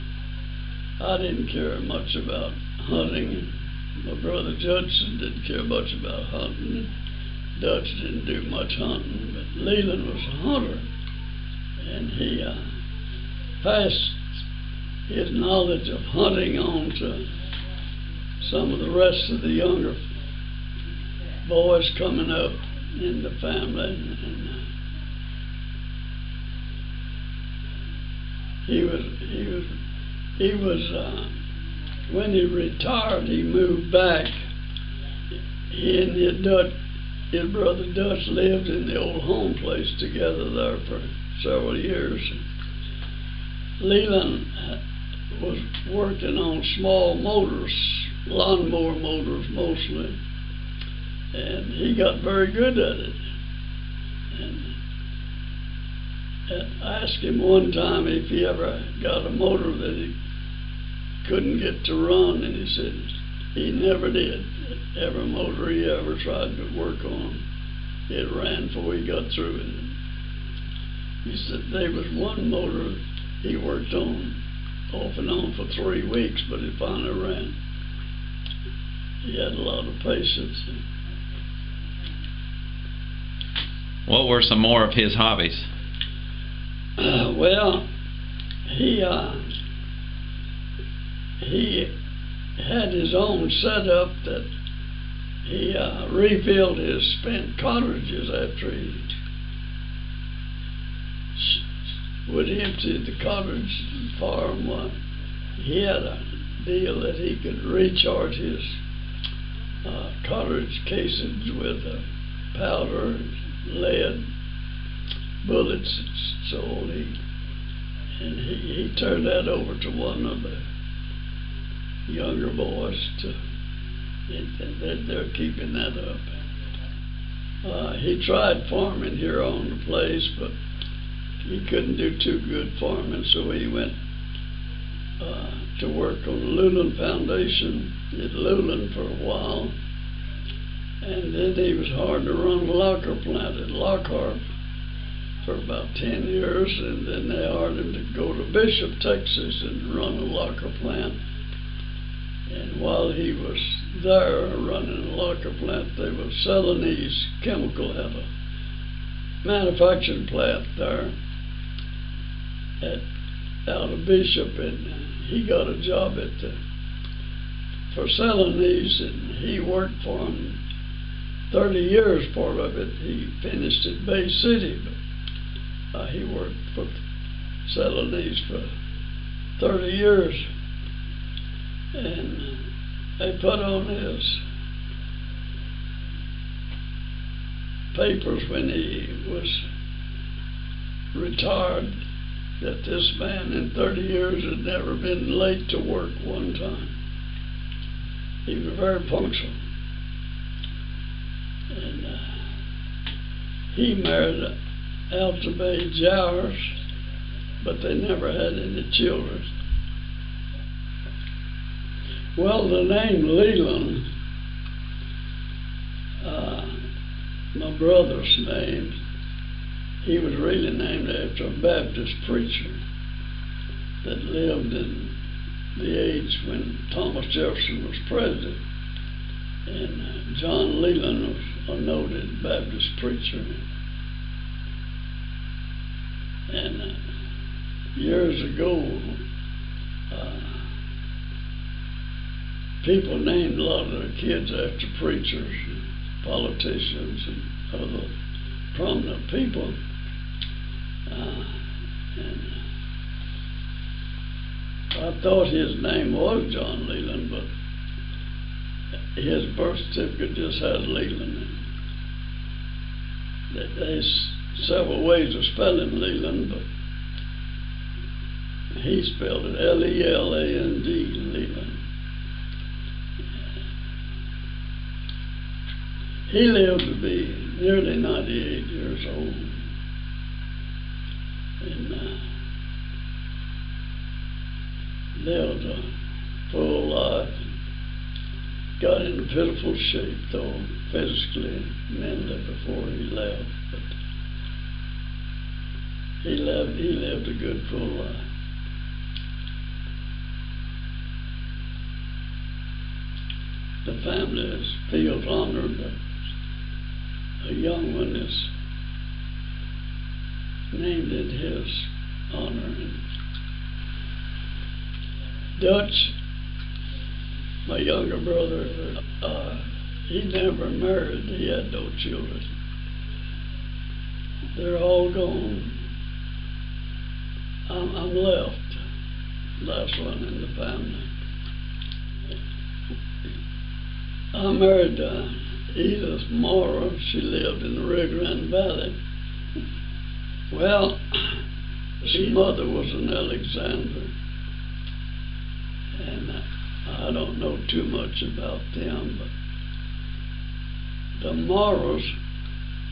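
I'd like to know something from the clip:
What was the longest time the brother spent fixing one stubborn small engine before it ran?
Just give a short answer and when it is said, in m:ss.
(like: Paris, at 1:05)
3 weeks, at 1:15.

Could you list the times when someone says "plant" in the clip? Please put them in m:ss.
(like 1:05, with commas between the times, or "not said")
2:23, 2:30, 2:35, 2:40.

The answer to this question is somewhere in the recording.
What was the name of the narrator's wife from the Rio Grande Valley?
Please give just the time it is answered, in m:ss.
5:35.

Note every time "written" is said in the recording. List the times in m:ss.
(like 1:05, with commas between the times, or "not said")
not said.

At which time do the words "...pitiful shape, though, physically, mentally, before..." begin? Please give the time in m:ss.
4:49.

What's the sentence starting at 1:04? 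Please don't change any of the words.
Every motor he ever tried to work on, it ran before he got through it.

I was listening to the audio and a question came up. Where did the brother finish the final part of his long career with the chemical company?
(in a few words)
Bay City.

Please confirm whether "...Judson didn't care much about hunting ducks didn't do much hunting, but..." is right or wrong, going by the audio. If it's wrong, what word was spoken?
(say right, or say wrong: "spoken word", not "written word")
right.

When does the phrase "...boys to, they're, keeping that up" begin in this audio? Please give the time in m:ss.
2:02.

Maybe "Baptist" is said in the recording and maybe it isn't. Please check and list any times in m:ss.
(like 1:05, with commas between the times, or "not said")
3:41, 3:52.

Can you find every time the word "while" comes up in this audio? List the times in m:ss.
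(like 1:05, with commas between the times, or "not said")
2:19, 2:32.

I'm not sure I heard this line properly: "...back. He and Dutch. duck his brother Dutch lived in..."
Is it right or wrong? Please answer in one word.
right.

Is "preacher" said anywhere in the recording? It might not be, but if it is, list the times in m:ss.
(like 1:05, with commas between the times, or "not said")
3:42, 3:52, 4:04.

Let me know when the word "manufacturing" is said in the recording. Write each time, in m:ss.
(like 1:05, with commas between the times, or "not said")
2:39.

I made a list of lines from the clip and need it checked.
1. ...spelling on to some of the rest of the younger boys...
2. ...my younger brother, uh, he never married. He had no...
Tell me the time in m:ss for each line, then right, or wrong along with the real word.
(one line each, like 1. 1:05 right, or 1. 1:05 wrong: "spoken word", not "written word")
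1. 0:16 wrong: "hunting", not "spelling"
2. 5:17 right.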